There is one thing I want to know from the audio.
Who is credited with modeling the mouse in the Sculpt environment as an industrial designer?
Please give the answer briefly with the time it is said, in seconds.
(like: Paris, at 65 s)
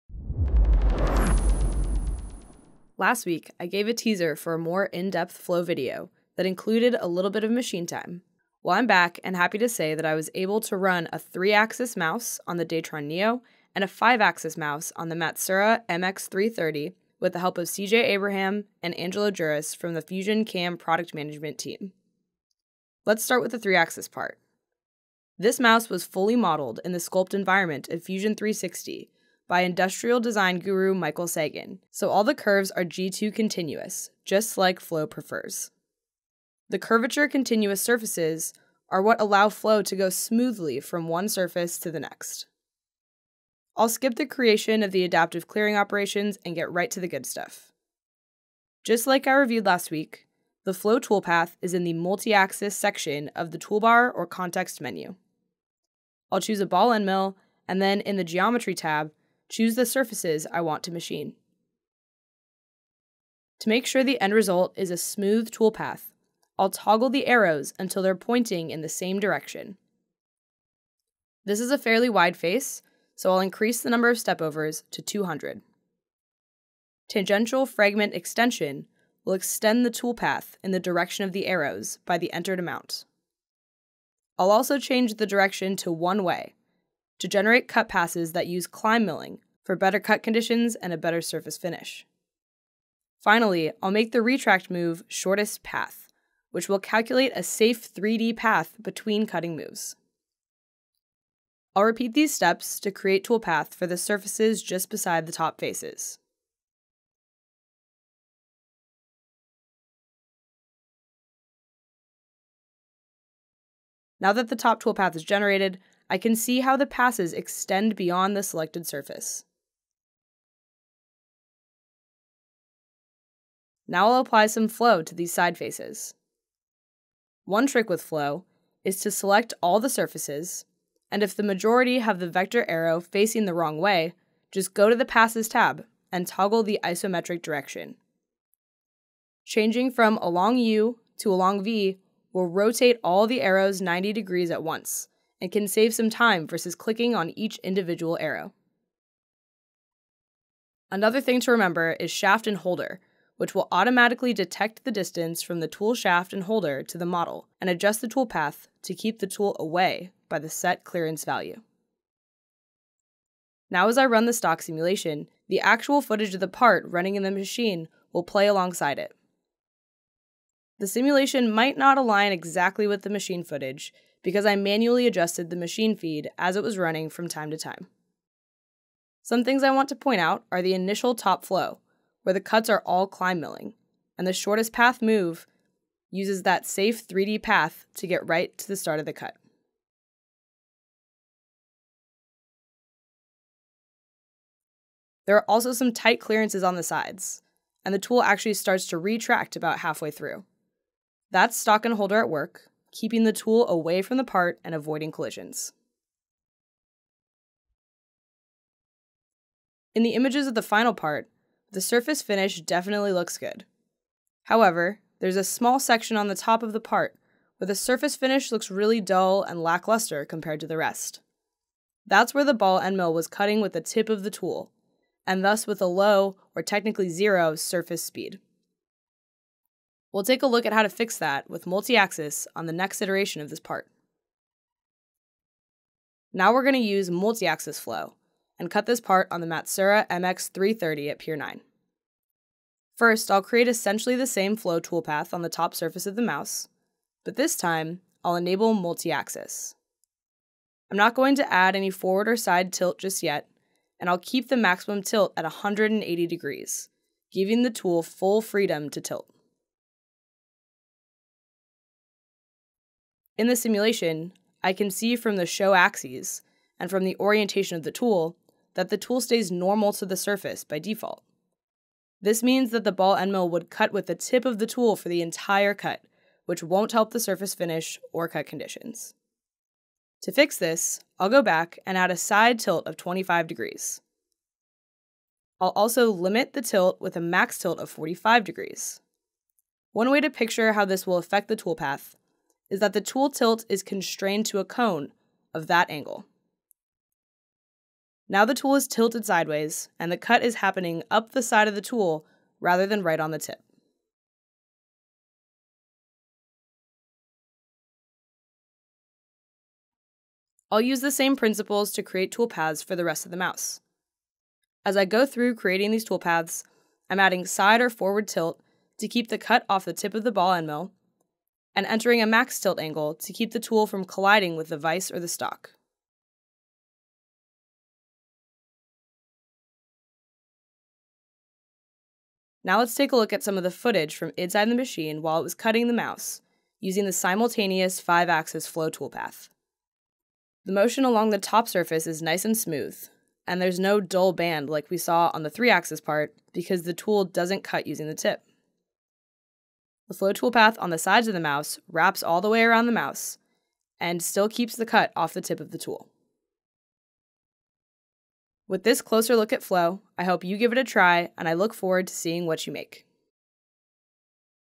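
Michael Sagan, at 30 s.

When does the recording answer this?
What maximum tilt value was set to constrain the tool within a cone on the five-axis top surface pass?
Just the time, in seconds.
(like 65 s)
287 s.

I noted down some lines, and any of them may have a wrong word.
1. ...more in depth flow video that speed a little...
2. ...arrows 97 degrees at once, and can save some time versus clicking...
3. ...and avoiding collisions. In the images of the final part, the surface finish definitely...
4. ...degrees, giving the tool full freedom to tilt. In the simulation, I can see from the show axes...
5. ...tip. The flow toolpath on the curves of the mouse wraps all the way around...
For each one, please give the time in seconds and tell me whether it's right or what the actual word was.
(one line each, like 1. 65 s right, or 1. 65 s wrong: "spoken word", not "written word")
1. 4 s wrong: "included", not "speed"
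2. 143 s wrong: "90", not "97"
3. 204 s right
4. 256 s right
5. 348 s wrong: "sides", not "curves".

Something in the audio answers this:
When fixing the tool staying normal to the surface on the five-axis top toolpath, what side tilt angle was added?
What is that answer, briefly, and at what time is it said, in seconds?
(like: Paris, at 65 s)
25 degrees, at 282 s.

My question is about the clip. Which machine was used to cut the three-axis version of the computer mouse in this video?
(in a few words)
Datron Neo.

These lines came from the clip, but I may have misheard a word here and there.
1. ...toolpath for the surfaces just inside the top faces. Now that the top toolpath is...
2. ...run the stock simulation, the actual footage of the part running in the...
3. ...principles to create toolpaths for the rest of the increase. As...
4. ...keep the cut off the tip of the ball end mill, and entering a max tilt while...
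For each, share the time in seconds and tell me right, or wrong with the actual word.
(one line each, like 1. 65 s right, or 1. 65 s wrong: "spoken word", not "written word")
1. 103 s wrong: "beside", not "inside"
2. 164 s right
3. 311 s wrong: "mouse", not "increase"
4. 319 s wrong: "angle", not "while".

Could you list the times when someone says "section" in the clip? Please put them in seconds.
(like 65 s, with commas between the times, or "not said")
52 s, 215 s.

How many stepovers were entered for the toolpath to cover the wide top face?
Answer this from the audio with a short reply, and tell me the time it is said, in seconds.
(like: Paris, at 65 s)
200, at 75 s.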